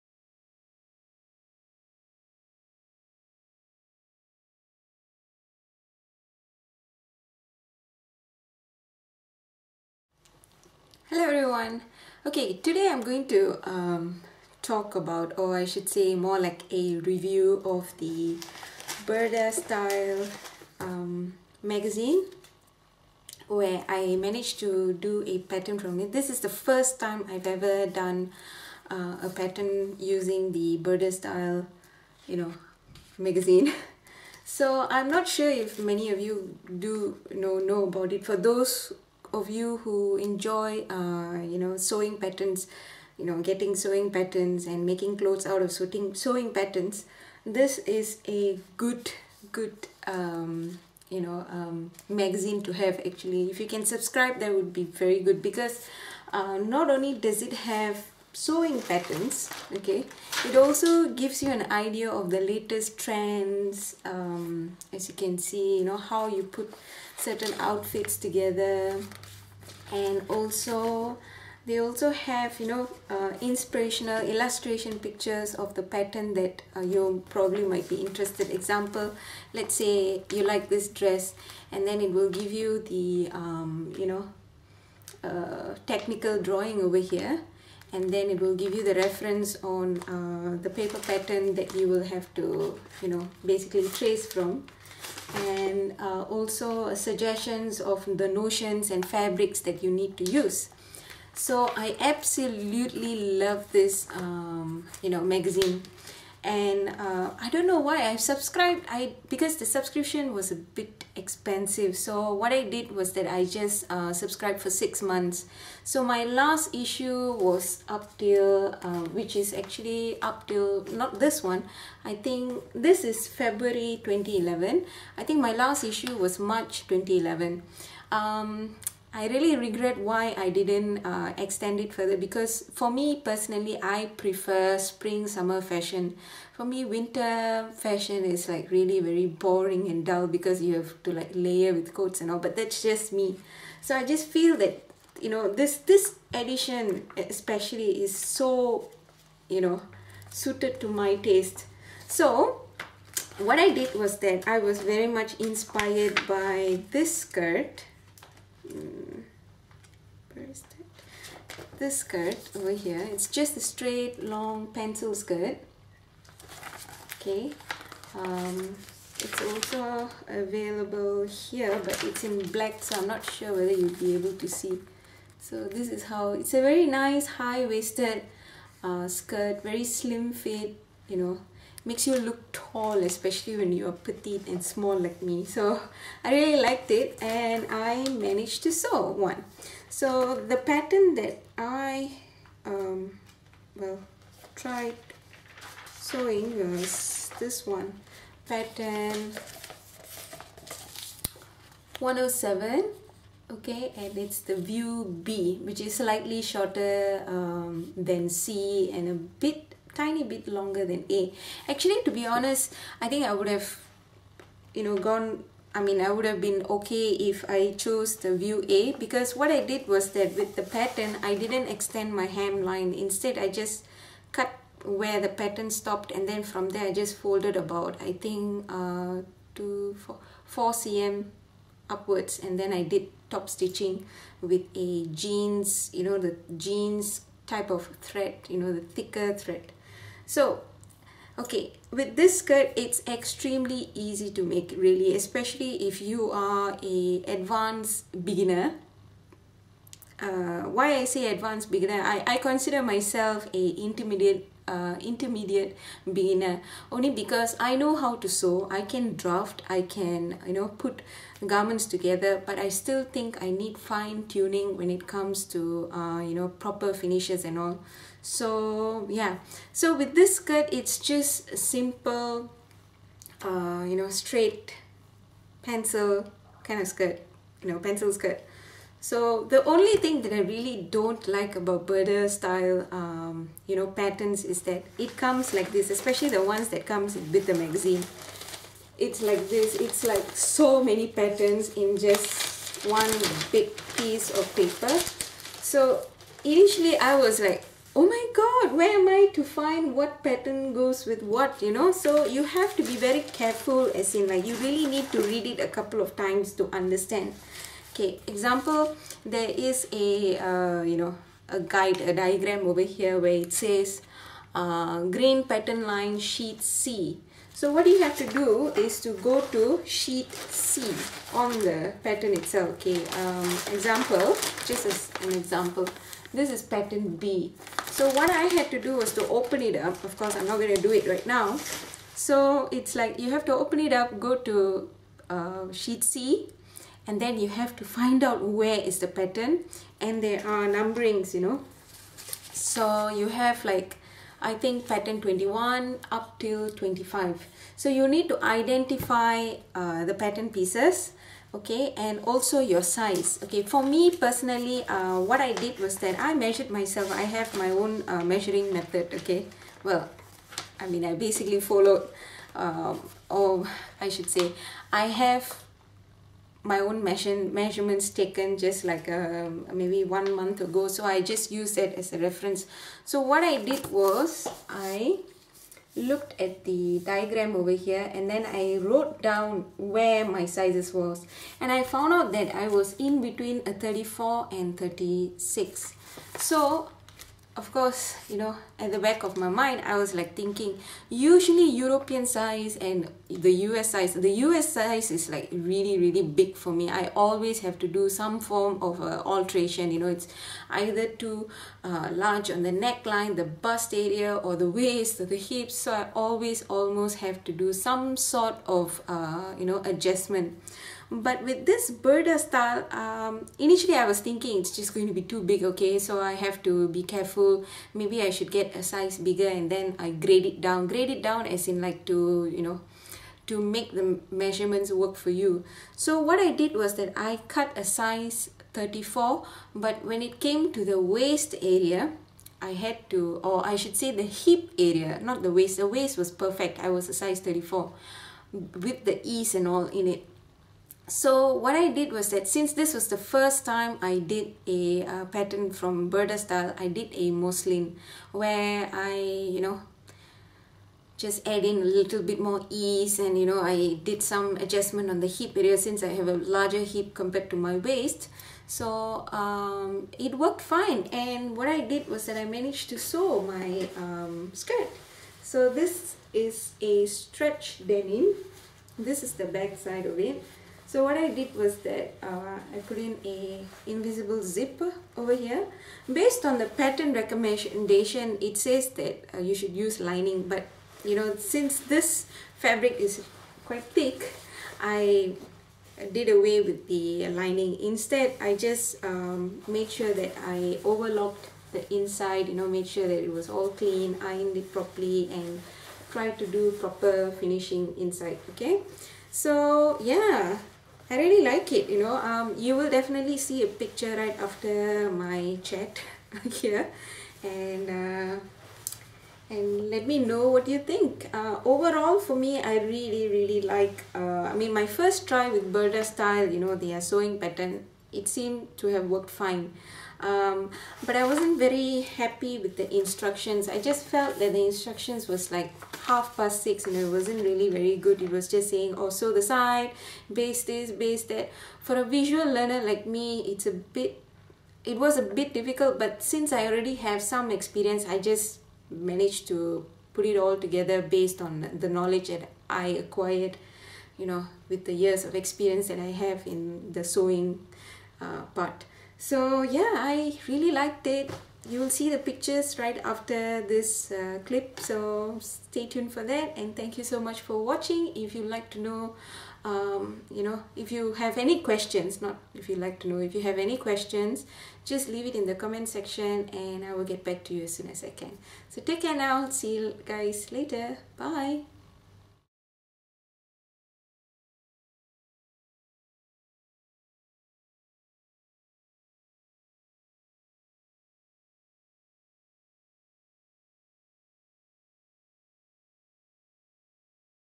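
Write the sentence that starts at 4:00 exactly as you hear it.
So, okay, with this skirt, it's extremely easy to make really, especially if you are a advanced beginner.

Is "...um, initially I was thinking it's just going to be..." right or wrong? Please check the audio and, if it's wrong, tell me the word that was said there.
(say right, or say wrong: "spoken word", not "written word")
right.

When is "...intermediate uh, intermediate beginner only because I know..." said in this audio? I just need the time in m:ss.
4:13.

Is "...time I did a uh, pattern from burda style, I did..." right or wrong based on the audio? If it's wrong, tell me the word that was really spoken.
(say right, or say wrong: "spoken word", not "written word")
right.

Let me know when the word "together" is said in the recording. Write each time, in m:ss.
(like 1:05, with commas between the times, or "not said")
1:08, 4:21, 9:00.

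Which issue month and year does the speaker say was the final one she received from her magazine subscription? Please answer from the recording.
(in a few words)
March 2011.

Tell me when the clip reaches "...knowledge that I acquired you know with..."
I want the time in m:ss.
9:01.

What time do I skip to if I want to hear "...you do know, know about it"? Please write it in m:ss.
0:36.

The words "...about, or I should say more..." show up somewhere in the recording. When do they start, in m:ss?
0:14.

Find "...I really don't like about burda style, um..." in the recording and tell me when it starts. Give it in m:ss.
4:40.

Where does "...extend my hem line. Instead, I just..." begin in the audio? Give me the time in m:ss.
3:41.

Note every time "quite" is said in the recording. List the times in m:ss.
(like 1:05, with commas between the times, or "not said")
8:03.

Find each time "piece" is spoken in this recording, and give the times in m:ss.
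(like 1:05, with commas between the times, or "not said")
4:53, 5:50.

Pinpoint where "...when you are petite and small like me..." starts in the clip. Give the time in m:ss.
3:03.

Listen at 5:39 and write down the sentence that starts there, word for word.
And there are numberings, you know.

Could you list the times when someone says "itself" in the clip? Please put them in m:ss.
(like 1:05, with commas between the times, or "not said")
5:22.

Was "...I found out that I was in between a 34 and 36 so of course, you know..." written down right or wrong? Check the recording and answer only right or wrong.
right.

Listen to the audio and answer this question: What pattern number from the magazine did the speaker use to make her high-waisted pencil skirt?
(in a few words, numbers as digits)
107.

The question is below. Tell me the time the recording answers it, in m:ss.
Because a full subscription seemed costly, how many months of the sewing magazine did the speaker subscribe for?
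1:54.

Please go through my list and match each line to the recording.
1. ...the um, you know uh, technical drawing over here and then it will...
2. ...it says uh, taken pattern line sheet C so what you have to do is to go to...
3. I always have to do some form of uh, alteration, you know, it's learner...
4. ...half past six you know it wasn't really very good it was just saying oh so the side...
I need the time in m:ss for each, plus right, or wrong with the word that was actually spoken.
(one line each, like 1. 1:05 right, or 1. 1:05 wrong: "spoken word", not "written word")
1. 1:22 right
2. 5:13 wrong: "green", not "taken"
3. 6:36 wrong: "either", not "learner"
4. 8:46 right.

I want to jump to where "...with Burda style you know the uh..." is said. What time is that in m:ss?
8:35.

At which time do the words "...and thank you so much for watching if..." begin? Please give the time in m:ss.
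9:16.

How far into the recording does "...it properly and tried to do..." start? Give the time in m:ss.
8:14.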